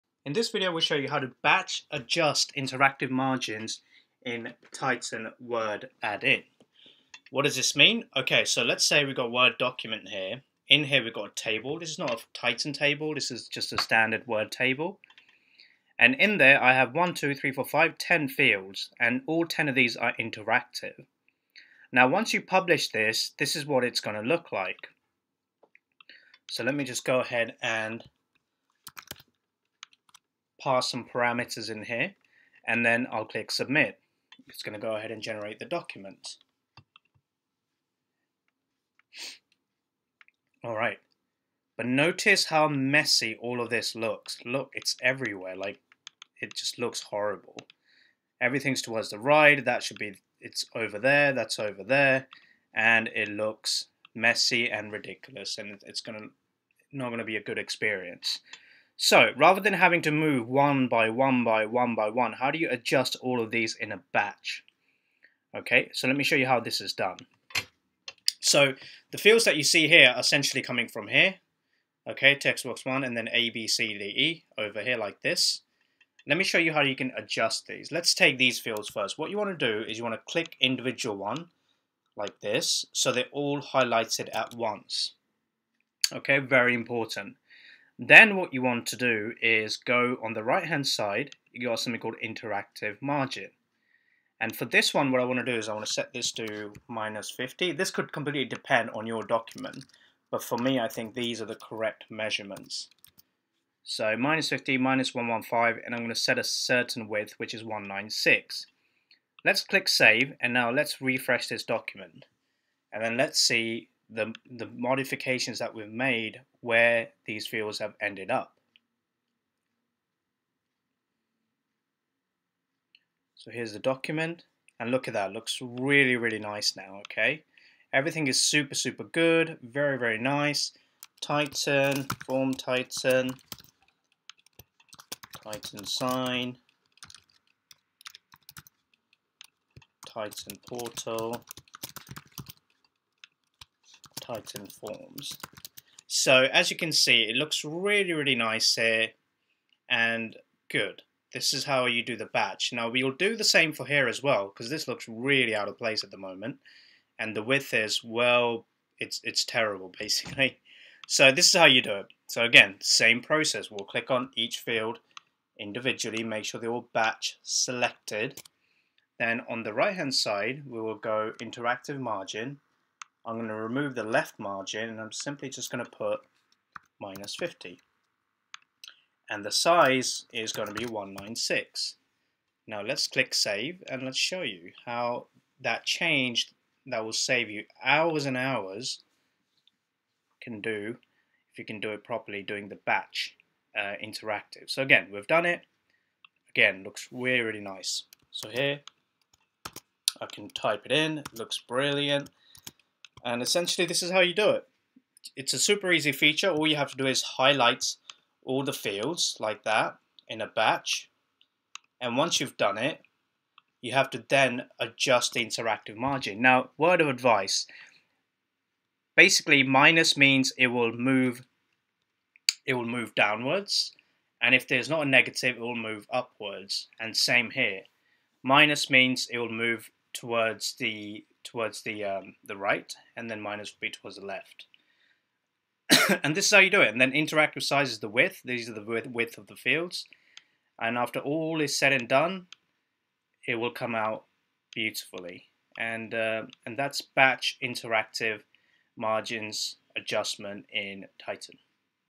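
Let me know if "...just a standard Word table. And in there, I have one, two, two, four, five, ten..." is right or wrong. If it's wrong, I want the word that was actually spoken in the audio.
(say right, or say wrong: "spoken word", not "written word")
wrong: "three", not "two".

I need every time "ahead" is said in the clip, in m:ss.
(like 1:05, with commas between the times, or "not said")
0:27, 0:34.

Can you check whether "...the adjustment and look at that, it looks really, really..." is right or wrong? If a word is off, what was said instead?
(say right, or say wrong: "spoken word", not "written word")
wrong: "document", not "adjustment".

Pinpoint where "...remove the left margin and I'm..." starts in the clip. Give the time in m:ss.
2:53.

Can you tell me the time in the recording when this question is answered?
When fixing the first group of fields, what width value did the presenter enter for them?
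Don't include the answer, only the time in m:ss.
1:47.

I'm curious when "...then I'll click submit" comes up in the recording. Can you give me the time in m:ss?
0:32.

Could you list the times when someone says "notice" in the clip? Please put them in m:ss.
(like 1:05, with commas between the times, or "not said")
0:41.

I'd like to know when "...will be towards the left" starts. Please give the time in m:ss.
3:53.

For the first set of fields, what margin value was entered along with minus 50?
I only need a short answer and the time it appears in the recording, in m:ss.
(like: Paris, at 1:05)
-115, at 1:44.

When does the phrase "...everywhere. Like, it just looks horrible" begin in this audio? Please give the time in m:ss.
0:45.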